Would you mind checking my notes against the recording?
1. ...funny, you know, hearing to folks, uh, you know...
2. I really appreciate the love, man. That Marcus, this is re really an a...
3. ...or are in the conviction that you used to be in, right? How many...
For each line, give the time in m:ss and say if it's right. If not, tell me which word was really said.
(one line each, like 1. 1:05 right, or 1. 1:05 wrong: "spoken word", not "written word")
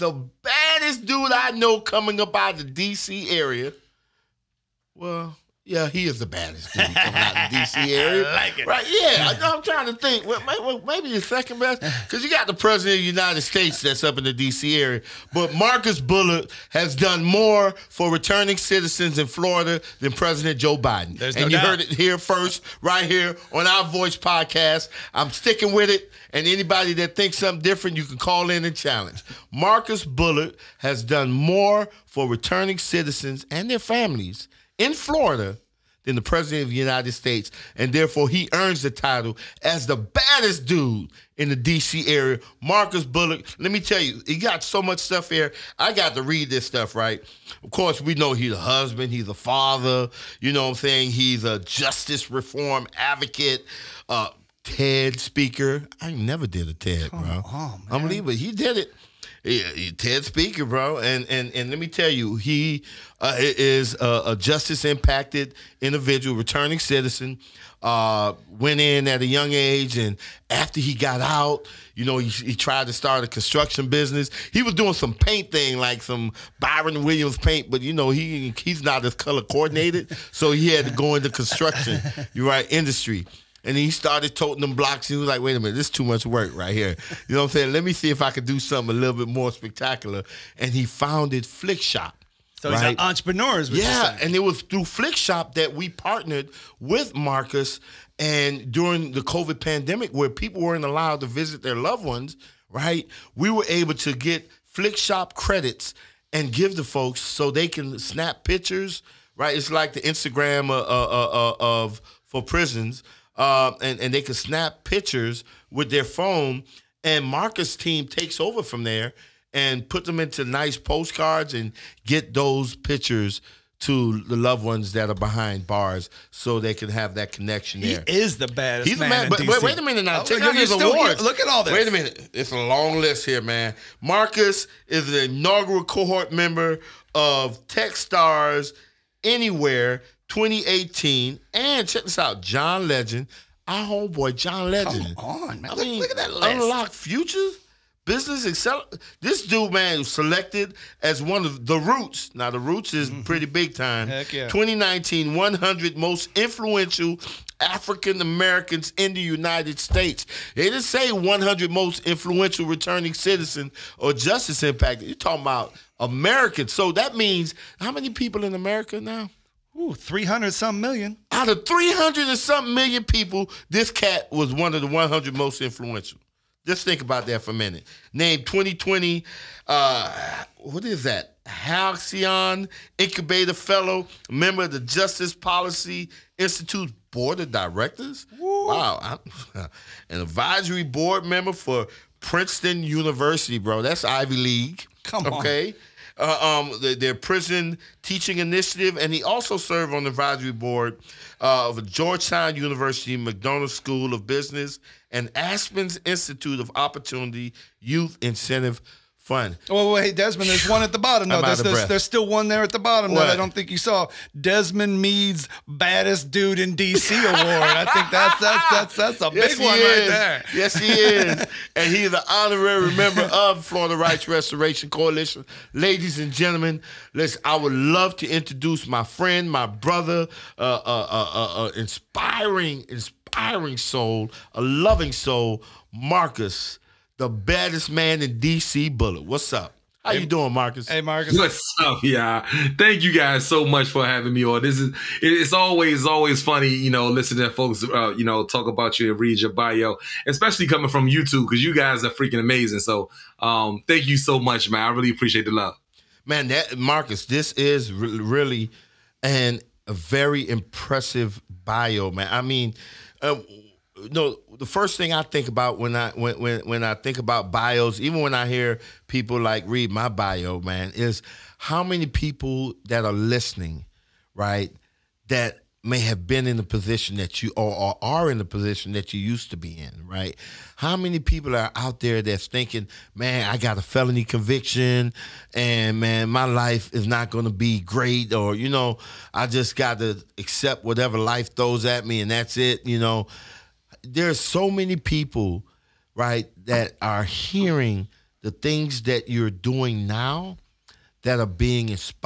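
1. 4:06 wrong: "listening", not "hearing"
2. 4:14 right
3. 4:37 wrong: "position", not "conviction".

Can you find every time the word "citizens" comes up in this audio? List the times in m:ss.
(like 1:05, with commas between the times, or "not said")
0:18, 0:32, 1:06, 2:43.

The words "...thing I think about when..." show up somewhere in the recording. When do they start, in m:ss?
4:24.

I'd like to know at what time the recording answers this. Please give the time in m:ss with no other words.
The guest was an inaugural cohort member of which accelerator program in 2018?
2:17.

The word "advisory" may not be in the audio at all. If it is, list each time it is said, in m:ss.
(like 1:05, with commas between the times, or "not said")
3:10, 3:20.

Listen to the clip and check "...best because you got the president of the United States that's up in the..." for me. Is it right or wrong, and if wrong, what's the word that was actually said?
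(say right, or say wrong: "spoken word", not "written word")
right.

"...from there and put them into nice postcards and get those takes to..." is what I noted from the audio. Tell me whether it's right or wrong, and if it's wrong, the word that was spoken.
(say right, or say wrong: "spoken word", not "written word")
wrong: "pictures", not "takes".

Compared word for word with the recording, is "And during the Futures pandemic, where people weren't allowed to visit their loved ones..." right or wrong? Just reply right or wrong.
wrong.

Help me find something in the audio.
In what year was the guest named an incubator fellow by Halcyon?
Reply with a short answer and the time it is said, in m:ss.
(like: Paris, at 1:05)
2020, at 2:58.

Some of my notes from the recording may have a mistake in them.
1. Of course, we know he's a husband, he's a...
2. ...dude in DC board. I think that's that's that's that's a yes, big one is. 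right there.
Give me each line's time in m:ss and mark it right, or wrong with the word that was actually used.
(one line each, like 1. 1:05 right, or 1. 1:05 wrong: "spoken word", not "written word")
1. 0:47 right
2. 3:36 wrong: "award", not "board".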